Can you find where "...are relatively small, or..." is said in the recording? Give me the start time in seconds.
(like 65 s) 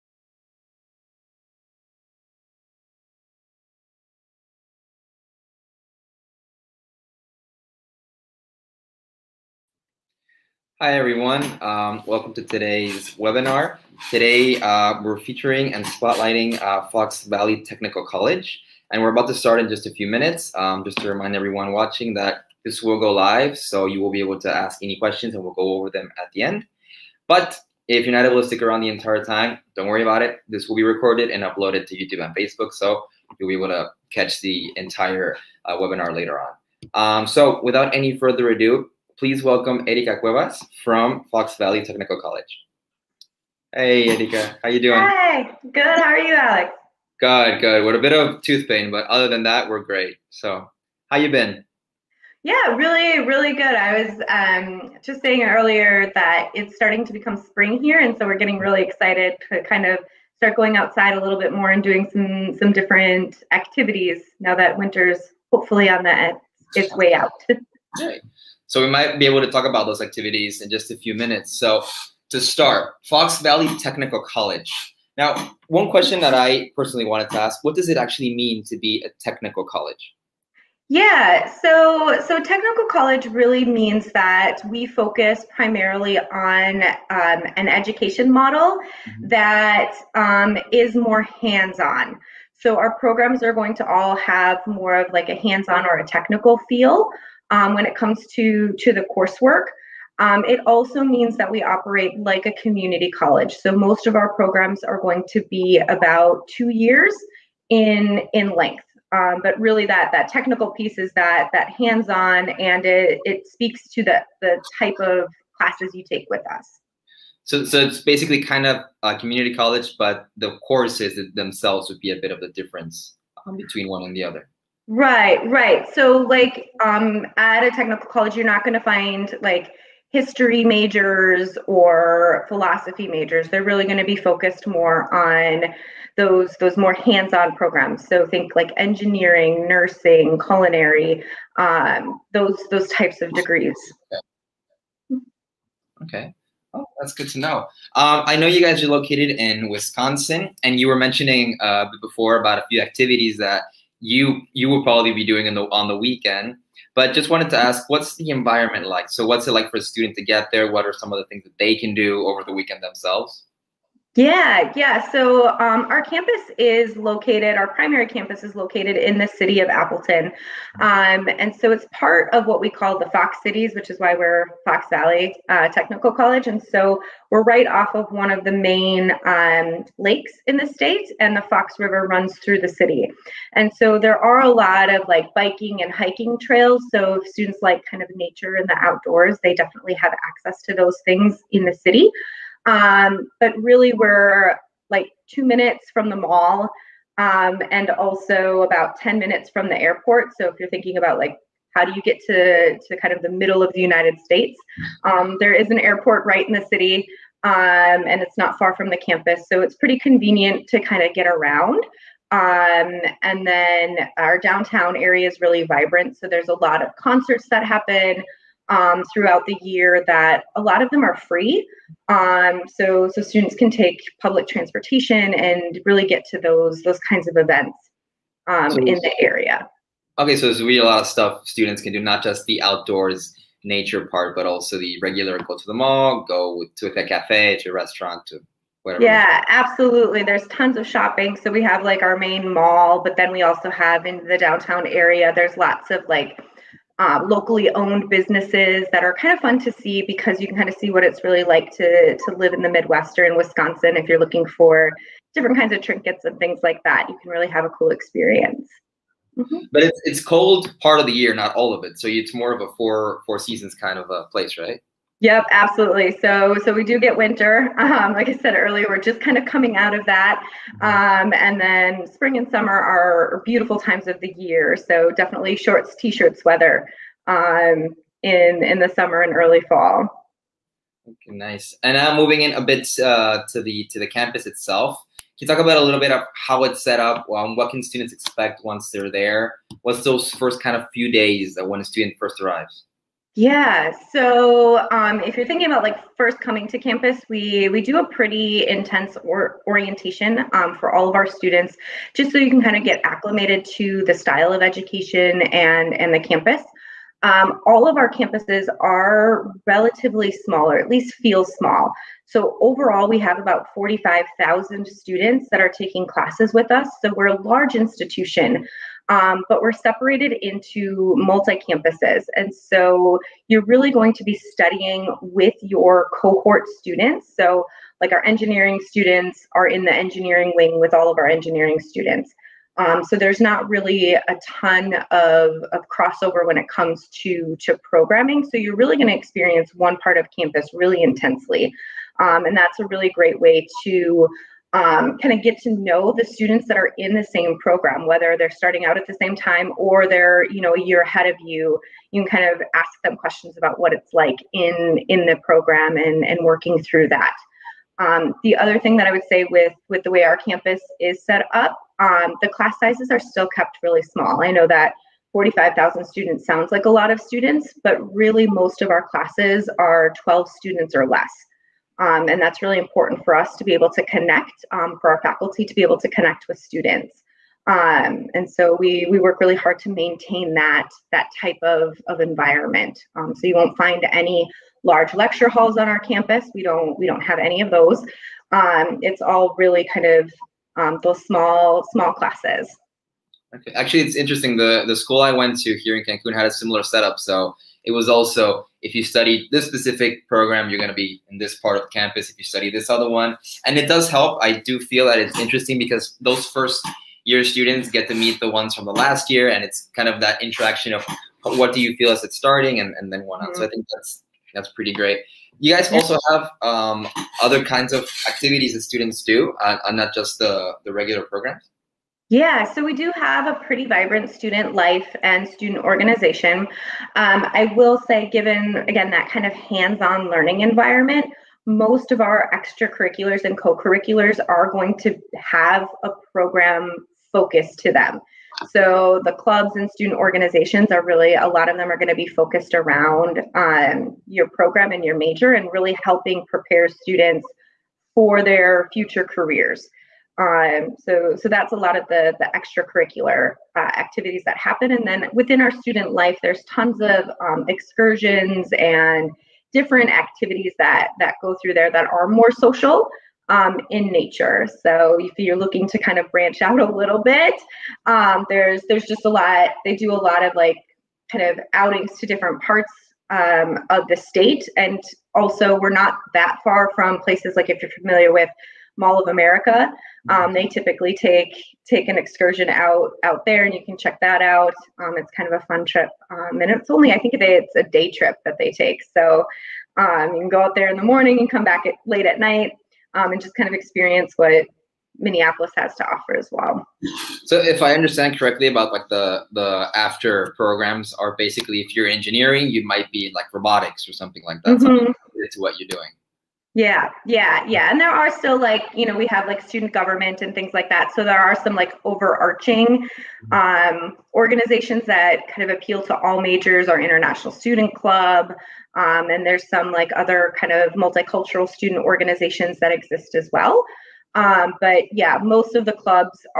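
308 s.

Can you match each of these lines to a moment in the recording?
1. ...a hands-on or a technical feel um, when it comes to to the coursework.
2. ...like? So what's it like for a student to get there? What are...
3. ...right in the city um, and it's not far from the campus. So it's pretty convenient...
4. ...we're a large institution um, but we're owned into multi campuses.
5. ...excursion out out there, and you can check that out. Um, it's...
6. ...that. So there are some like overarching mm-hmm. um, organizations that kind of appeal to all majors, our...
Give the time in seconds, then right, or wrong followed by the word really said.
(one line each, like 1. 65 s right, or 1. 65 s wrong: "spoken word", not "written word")
1. 95 s right
2. 158 s right
3. 206 s right
4. 317 s wrong: "separated", not "owned"
5. 482 s right
6. 510 s right.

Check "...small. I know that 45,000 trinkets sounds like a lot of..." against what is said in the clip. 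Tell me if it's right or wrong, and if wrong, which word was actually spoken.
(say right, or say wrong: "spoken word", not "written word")
wrong: "students", not "trinkets".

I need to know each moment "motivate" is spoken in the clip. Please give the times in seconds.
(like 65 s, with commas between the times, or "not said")
not said.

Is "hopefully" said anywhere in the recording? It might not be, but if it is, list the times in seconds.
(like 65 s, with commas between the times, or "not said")
65 s.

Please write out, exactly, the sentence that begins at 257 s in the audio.
You can really have a cool experience.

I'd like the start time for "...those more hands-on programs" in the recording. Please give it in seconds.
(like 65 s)
136 s.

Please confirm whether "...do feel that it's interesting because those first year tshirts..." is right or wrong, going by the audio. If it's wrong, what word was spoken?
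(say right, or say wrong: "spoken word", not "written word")
wrong: "students", not "tshirts".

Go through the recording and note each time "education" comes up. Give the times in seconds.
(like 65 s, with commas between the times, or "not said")
87 s, 304 s.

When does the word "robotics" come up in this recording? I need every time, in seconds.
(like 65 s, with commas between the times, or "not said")
503 s.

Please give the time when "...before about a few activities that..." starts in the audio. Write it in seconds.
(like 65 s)
152 s.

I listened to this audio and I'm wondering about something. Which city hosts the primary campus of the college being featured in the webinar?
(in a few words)
Appleton.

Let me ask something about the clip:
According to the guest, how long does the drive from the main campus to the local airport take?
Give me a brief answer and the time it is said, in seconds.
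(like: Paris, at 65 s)
10 minutes, at 198 s.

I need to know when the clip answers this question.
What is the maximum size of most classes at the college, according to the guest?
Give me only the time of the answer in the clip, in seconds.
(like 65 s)
370 s.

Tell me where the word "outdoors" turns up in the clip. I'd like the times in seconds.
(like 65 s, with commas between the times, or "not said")
188 s, 232 s.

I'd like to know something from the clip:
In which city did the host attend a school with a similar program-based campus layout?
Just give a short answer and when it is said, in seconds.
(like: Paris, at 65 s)
Cancun, at 396 s.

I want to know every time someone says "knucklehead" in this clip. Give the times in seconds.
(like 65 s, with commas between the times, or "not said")
not said.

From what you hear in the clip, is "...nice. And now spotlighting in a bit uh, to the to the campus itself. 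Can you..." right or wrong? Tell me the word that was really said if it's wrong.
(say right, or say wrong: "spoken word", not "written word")
wrong: "moving", not "spotlighting".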